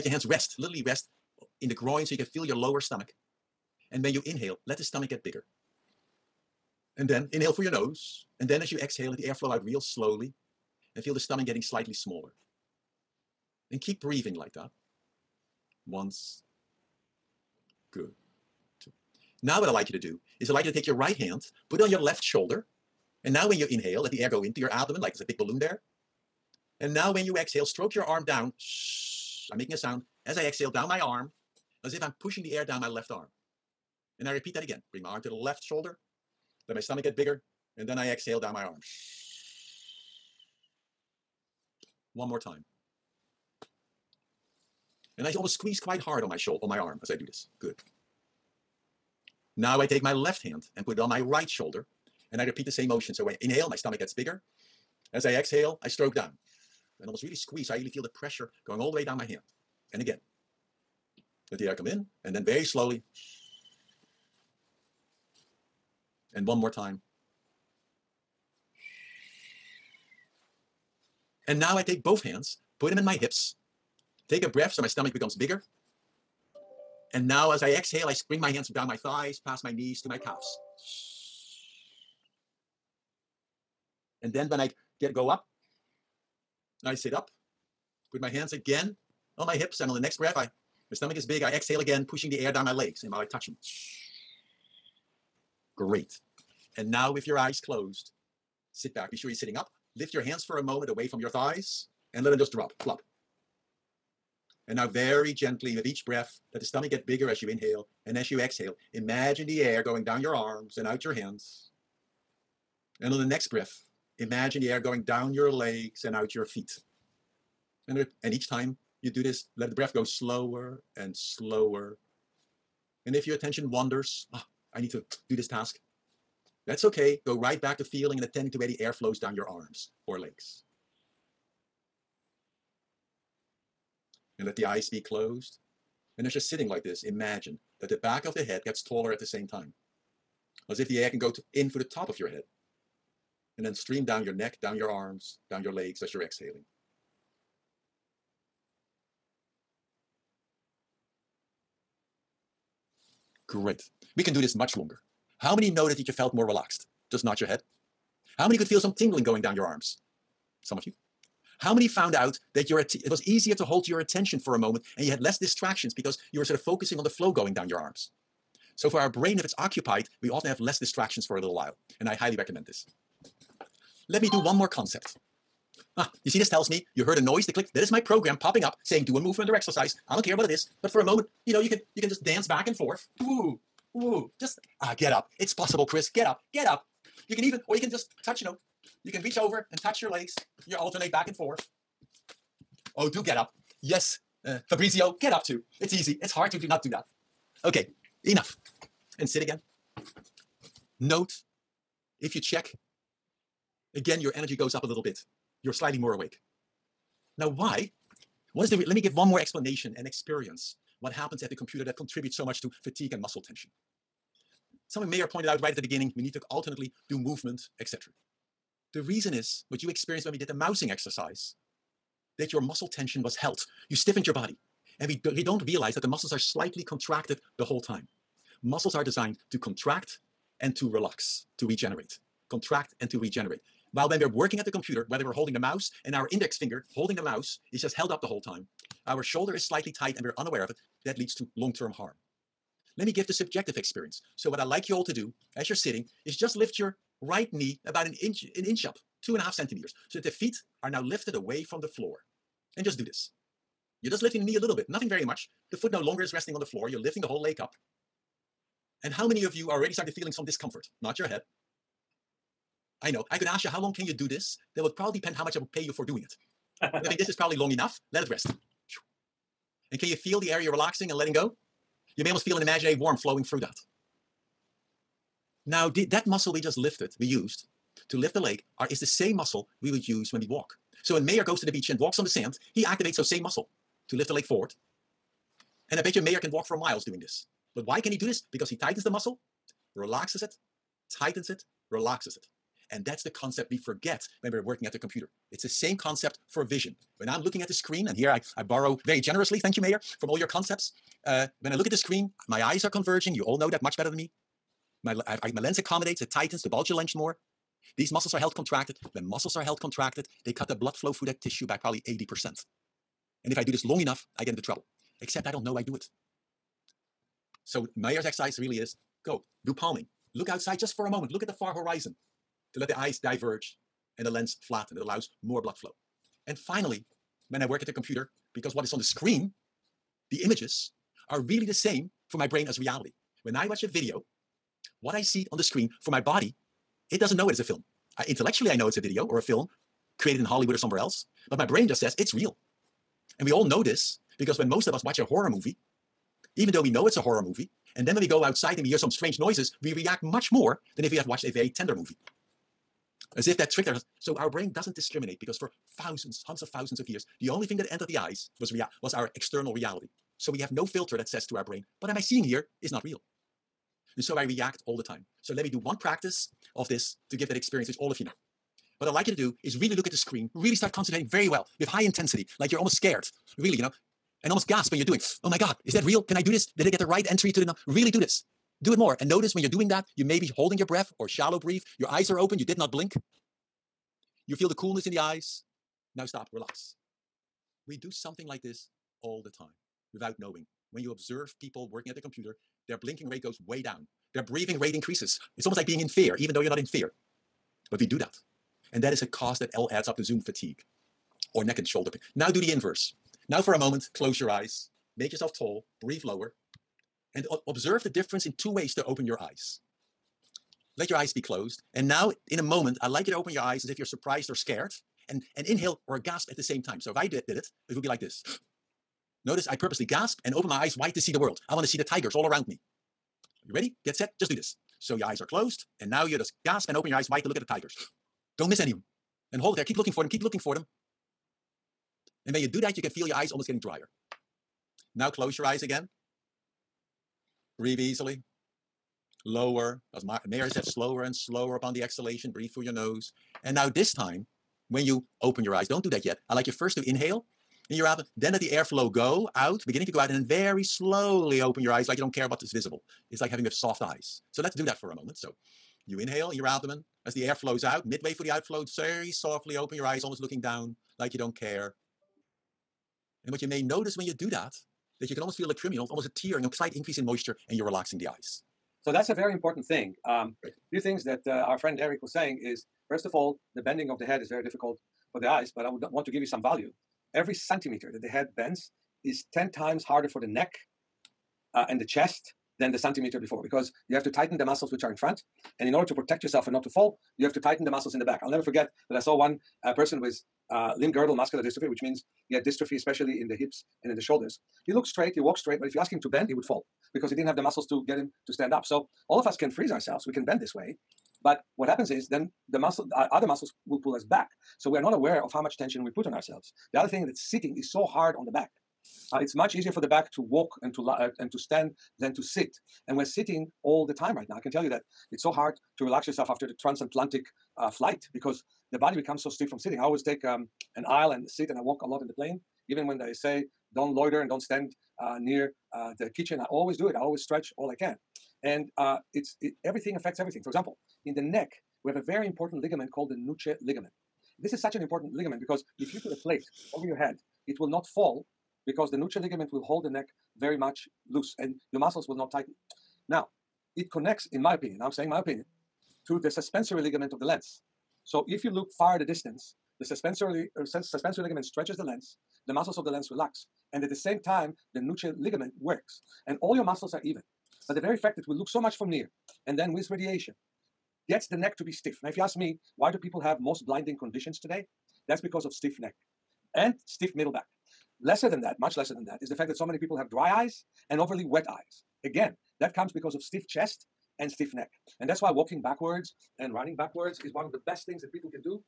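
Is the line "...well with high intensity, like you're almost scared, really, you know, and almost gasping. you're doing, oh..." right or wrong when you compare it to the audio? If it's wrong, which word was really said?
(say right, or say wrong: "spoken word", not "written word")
right.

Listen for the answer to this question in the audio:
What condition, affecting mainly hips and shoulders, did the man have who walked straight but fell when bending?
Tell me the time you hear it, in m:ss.
8:10.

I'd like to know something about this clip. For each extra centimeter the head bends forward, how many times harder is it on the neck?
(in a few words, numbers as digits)
10.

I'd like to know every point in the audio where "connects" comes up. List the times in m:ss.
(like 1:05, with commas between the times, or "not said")
9:04.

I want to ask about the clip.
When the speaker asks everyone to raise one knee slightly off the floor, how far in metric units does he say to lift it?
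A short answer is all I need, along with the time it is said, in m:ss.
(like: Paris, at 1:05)
2.5 centimeters, at 4:09.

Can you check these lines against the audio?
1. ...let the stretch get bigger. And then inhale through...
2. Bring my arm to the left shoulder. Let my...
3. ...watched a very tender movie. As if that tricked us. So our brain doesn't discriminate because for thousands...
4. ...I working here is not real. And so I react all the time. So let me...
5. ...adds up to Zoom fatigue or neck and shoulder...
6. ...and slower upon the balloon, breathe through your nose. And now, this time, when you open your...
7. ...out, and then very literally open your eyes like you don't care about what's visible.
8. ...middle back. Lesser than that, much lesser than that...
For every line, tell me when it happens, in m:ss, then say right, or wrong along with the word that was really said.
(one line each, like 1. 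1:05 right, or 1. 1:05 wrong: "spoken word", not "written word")
1. 0:04 wrong: "stomach", not "stretch"
2. 0:34 right
3. 5:51 right
4. 6:02 wrong: "seeing", not "working"
5. 6:39 right
6. 7:21 wrong: "exhalation", not "balloon"
7. 7:30 wrong: "slowly", not "literally"
8. 9:27 right.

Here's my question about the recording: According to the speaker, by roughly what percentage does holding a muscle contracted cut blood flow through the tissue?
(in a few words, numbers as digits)
80%.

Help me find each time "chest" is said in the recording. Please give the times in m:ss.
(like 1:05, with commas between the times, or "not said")
8:02, 9:33.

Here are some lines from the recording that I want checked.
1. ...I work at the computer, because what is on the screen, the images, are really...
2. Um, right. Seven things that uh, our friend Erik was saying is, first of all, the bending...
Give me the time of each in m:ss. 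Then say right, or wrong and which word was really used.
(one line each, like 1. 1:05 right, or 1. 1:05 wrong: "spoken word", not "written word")
1. 5:27 right
2. 7:50 wrong: "Two", not "Seven".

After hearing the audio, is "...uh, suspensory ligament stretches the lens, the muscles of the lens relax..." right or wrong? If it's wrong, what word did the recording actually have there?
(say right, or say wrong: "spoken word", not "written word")
right.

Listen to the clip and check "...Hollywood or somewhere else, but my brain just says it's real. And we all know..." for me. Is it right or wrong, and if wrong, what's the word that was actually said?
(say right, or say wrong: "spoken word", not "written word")
right.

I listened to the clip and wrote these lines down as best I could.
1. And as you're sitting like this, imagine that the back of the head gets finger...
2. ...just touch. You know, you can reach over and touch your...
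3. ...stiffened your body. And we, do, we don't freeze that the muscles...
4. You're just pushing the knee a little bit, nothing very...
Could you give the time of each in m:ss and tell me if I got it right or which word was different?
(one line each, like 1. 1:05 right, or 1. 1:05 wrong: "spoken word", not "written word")
1. 2:16 wrong: "taller", not "finger"
2. 3:07 right
3. 3:43 wrong: "realize", not "freeze"
4. 4:14 wrong: "lifting", not "pushing".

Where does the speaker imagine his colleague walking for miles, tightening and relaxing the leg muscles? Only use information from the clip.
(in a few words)
The beach.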